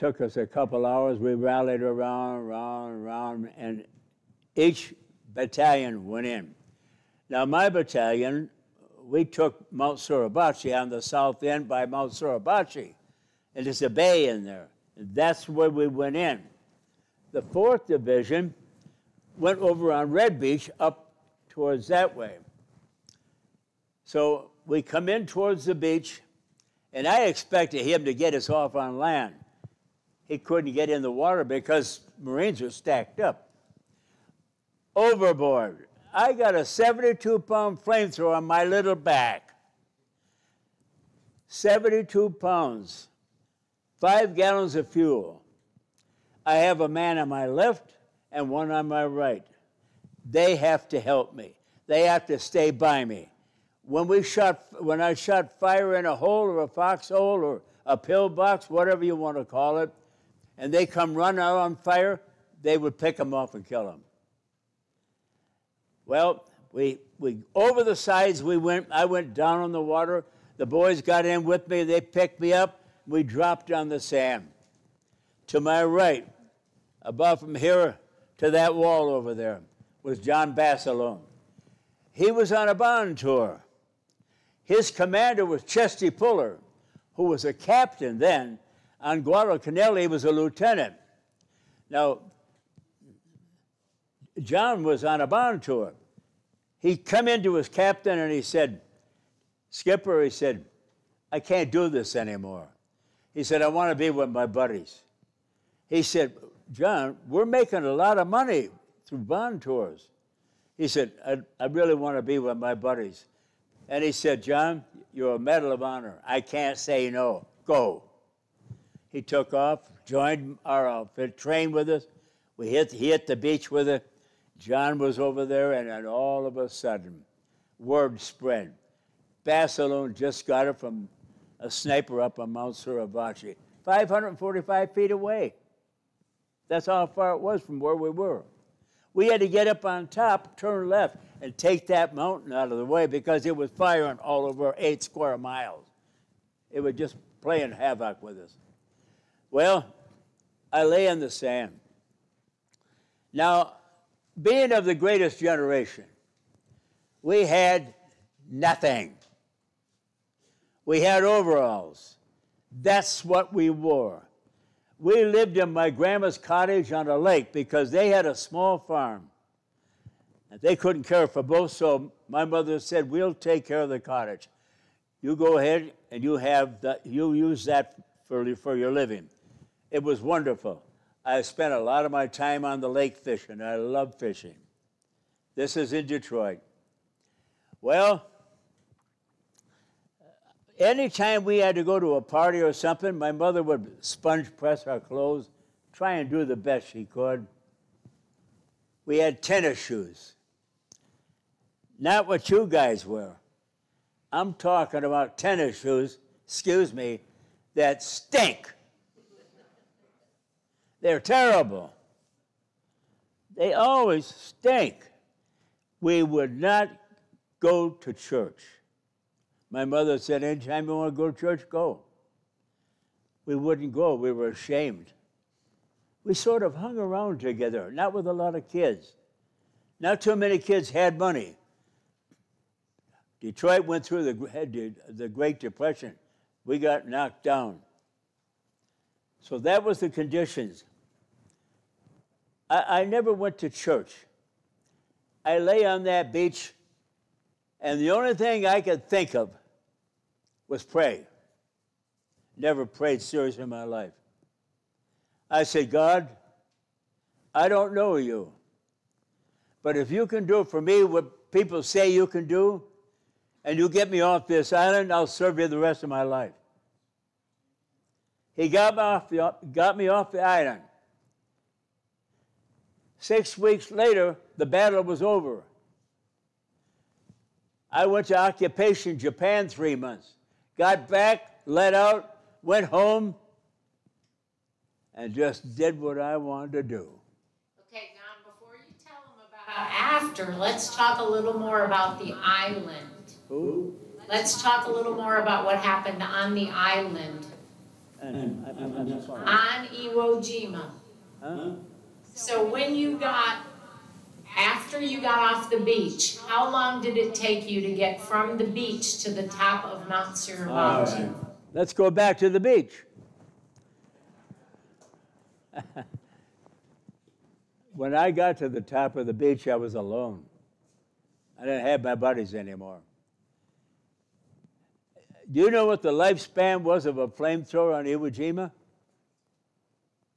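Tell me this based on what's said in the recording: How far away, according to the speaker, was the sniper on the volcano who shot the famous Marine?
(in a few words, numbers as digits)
545 feet.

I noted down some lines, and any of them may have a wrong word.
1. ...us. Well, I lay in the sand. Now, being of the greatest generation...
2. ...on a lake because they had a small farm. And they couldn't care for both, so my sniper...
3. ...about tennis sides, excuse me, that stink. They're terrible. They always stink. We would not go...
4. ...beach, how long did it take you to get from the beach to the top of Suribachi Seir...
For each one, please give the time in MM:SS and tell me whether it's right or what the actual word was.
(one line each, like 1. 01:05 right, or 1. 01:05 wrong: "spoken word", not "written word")
1. 02:28 right
2. 02:46 wrong: "mother", not "sniper"
3. 03:25 wrong: "shoes", not "sides"
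4. 05:05 wrong: "Mount", not "Suribachi".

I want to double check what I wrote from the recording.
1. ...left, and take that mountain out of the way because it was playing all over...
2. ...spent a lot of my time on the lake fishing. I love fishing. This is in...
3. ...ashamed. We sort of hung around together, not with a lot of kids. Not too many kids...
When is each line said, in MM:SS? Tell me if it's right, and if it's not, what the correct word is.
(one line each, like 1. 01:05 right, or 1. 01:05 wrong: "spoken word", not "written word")
1. 02:20 wrong: "firing", not "playing"
2. 03:01 right
3. 03:44 right.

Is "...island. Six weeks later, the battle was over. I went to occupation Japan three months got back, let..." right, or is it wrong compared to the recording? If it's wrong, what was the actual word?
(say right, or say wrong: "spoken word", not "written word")
right.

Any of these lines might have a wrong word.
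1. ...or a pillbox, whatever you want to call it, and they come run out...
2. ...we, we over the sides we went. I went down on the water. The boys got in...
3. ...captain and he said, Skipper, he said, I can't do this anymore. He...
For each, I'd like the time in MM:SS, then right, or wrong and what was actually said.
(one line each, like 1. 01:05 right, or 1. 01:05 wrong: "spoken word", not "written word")
1. 00:57 right
2. 01:06 right
3. 01:37 right.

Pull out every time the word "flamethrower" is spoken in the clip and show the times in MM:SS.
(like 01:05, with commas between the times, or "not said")
00:37, 05:27.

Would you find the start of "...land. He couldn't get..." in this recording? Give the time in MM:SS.
00:28.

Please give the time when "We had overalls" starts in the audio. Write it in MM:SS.
02:40.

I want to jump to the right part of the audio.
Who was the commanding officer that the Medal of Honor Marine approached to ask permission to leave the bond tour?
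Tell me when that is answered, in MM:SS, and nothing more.
01:25.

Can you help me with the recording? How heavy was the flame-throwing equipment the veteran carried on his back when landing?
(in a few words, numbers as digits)
72 pounds.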